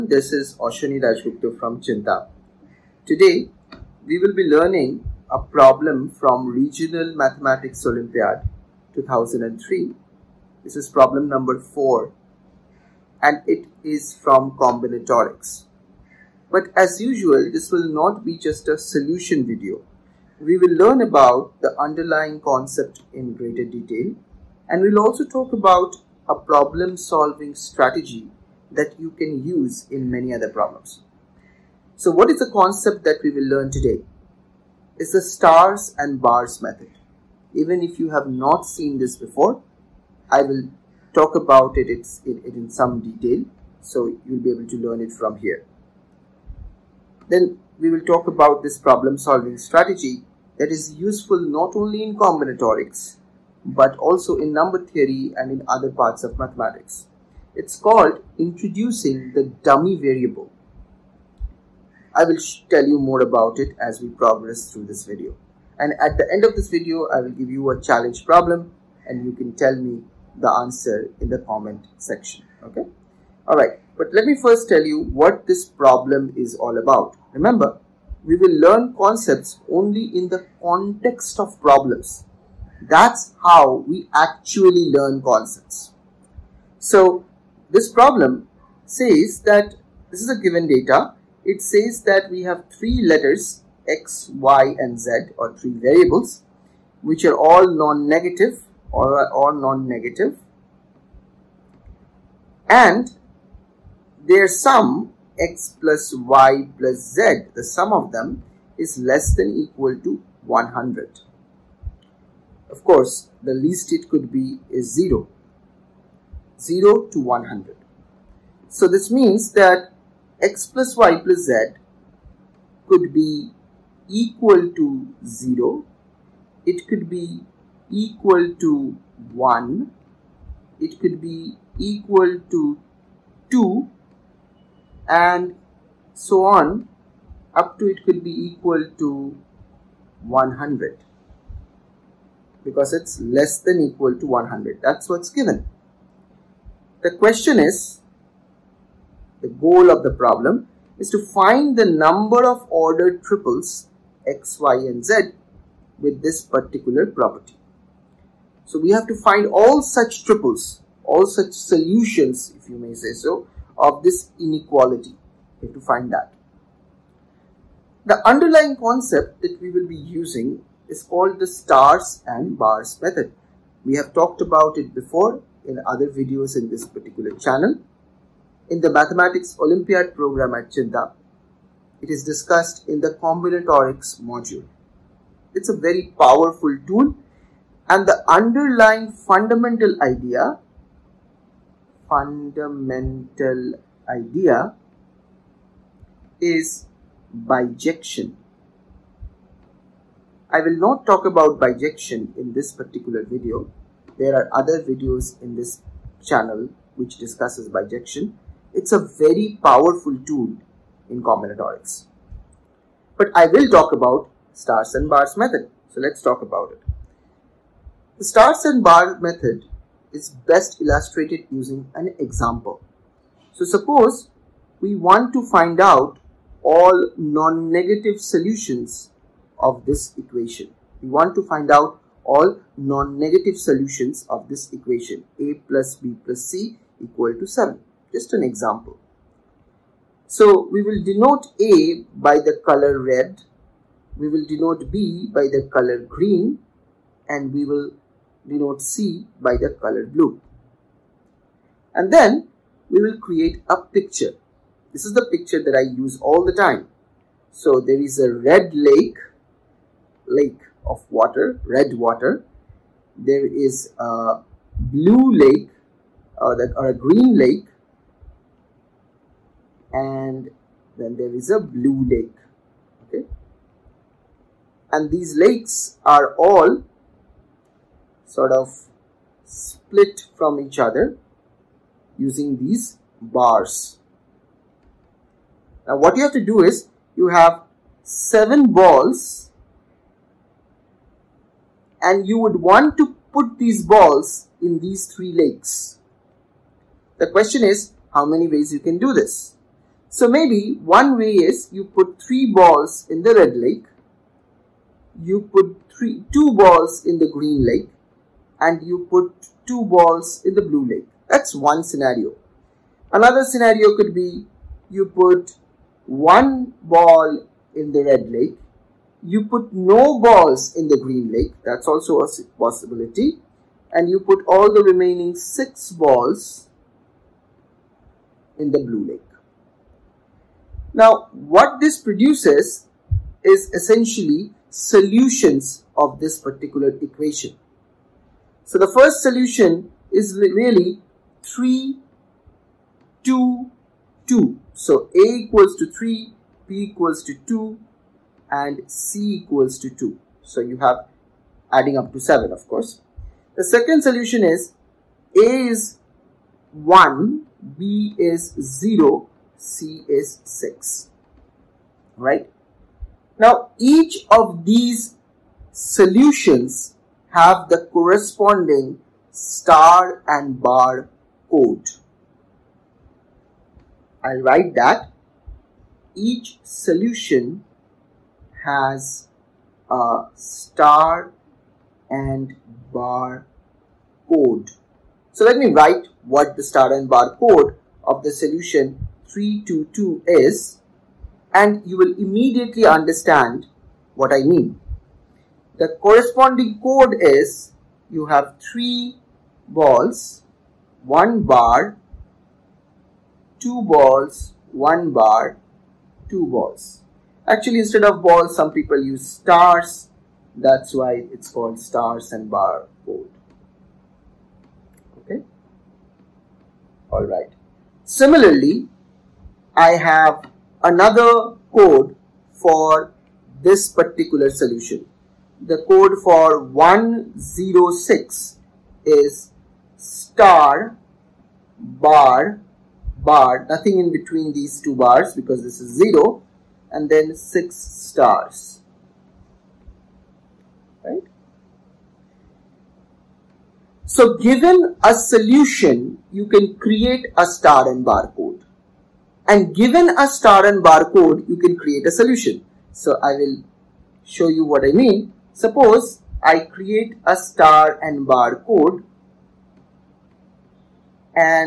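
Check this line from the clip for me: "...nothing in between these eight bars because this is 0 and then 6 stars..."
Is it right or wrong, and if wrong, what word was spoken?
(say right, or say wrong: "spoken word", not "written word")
wrong: "two", not "eight".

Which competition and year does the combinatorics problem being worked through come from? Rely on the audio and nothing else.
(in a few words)
Regional Mathematics Olympiad 2003.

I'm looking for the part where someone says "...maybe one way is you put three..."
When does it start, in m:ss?
5:00.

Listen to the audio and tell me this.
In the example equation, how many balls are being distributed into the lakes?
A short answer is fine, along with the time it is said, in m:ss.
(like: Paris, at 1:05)
7, at 4:48.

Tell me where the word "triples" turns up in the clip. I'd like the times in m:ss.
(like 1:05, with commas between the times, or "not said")
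2:33, 2:40.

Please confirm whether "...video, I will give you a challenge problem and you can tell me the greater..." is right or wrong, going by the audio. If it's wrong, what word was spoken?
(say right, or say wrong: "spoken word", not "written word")
wrong: "answer", not "greater".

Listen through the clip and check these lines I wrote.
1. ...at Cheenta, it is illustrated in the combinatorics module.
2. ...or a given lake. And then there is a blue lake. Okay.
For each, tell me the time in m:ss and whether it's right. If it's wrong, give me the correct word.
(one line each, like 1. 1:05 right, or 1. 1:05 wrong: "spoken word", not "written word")
1. 3:00 wrong: "discussed", not "illustrated"
2. 4:26 wrong: "green", not "given".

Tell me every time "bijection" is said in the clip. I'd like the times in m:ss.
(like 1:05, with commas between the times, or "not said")
3:17, 3:21, 3:27.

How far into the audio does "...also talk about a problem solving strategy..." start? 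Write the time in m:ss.
0:25.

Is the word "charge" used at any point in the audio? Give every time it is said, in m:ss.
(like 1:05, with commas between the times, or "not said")
not said.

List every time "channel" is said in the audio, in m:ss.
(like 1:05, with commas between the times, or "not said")
2:57, 3:26.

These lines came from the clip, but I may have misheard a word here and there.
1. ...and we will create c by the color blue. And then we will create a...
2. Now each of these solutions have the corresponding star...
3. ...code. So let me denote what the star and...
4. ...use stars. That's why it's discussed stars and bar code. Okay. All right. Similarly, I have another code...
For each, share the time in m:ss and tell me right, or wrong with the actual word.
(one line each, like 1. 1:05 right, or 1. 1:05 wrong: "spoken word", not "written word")
1. 4:07 wrong: "denote", not "create"
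2. 6:03 right
3. 6:24 wrong: "write", not "denote"
4. 6:49 wrong: "called", not "discussed".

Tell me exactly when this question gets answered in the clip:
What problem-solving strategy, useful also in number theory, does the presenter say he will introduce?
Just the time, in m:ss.
0:58.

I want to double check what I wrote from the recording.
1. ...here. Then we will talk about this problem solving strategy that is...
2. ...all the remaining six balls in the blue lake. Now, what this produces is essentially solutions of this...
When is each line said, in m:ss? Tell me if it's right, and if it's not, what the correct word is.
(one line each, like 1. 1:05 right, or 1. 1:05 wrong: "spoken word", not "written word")
1. 0:45 right
2. 5:24 right.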